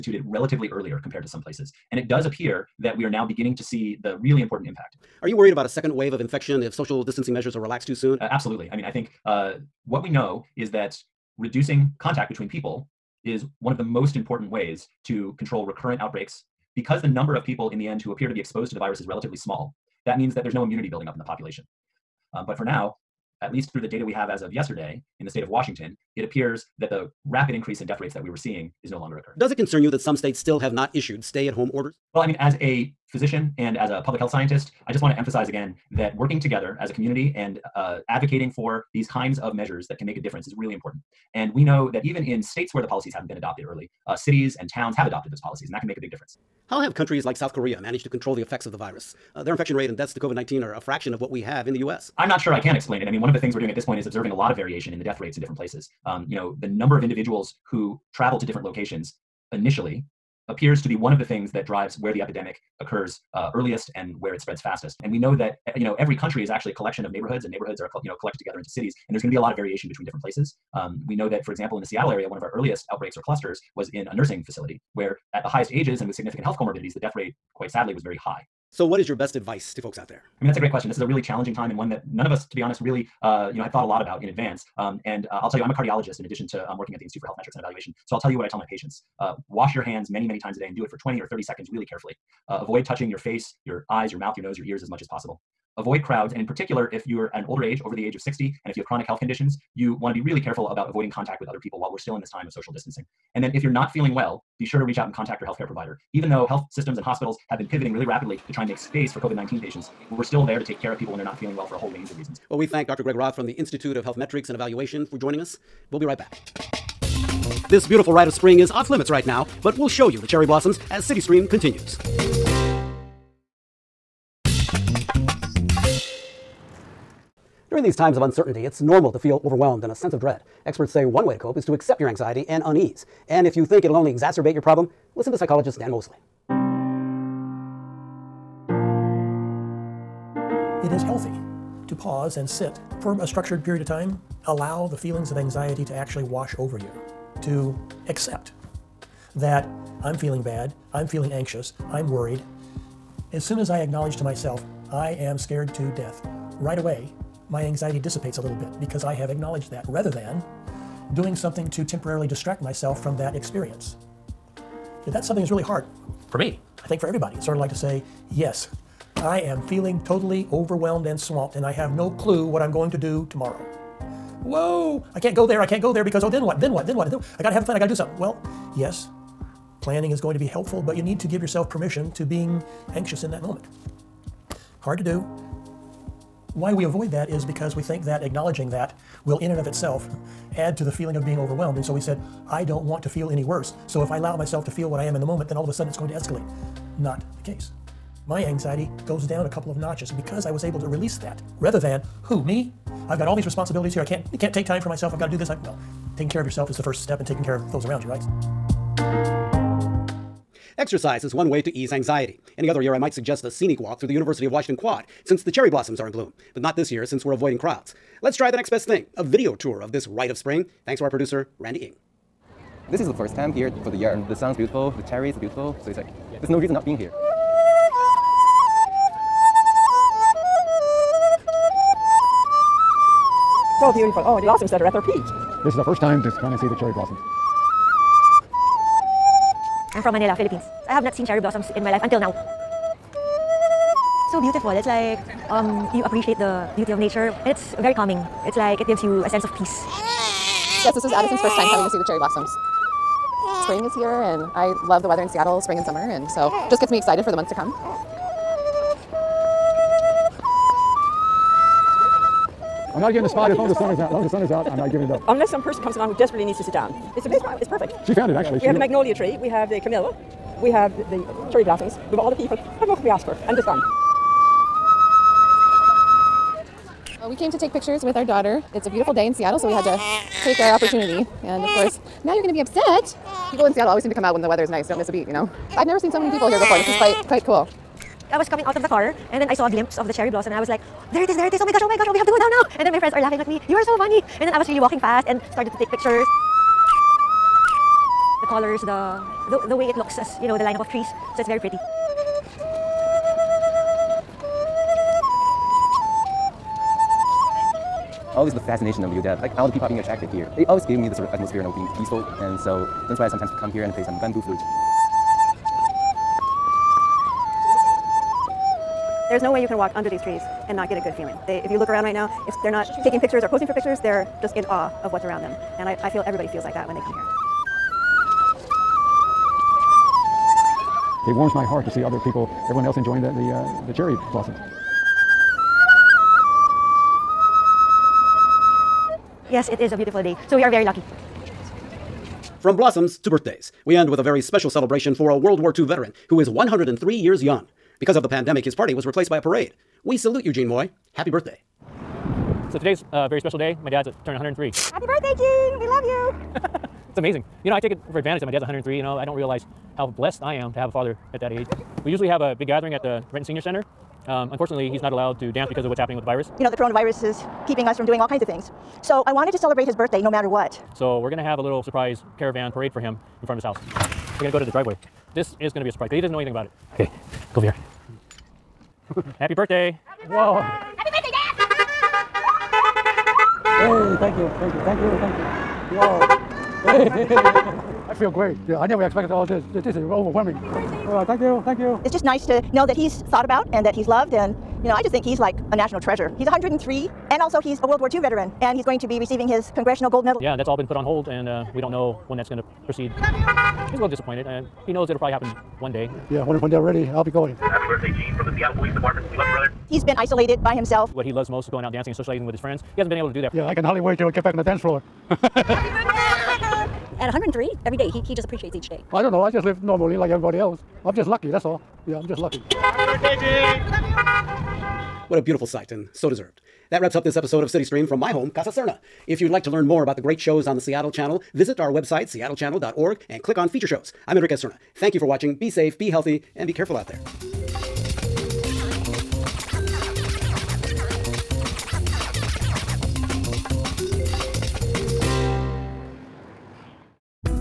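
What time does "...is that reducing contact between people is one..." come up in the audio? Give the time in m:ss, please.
0:10.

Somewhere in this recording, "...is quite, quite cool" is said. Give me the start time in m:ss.
4:46.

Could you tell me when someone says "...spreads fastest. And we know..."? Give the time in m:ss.
1:04.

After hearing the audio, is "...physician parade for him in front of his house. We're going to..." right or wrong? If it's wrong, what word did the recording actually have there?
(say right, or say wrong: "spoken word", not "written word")
wrong: "caravan", not "physician".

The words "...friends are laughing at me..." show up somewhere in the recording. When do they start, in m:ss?
4:52.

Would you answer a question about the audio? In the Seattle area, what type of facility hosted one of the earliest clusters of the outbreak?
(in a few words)
Nursing facility.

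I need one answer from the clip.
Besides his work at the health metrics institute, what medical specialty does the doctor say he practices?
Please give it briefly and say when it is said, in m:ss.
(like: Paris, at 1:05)
Cardiologist, at 1:25.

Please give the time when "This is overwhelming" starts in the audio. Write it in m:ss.
6:29.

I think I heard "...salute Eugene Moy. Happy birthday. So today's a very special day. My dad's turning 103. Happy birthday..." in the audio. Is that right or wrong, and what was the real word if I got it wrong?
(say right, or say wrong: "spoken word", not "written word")
right.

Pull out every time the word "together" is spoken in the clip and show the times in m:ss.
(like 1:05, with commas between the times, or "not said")
0:36, 1:08.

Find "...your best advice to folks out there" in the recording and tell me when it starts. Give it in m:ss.
1:19.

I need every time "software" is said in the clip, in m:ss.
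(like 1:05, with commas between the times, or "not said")
not said.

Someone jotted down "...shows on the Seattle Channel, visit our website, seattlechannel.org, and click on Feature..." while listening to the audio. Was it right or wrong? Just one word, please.
right.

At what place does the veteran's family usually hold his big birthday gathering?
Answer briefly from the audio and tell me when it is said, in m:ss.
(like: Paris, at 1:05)
Renton Senior Center, at 6:03.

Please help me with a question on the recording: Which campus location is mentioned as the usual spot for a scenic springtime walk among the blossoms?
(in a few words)
University of Washington Quad.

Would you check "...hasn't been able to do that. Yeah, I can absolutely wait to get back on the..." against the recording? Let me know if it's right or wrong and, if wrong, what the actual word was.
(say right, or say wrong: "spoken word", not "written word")
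wrong: "hardly", not "absolutely".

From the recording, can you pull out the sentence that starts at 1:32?
Uh, avoid touching your face, your eyes, your mouth, your nose, your ears as much as possible.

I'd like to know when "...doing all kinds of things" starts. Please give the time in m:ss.
6:08.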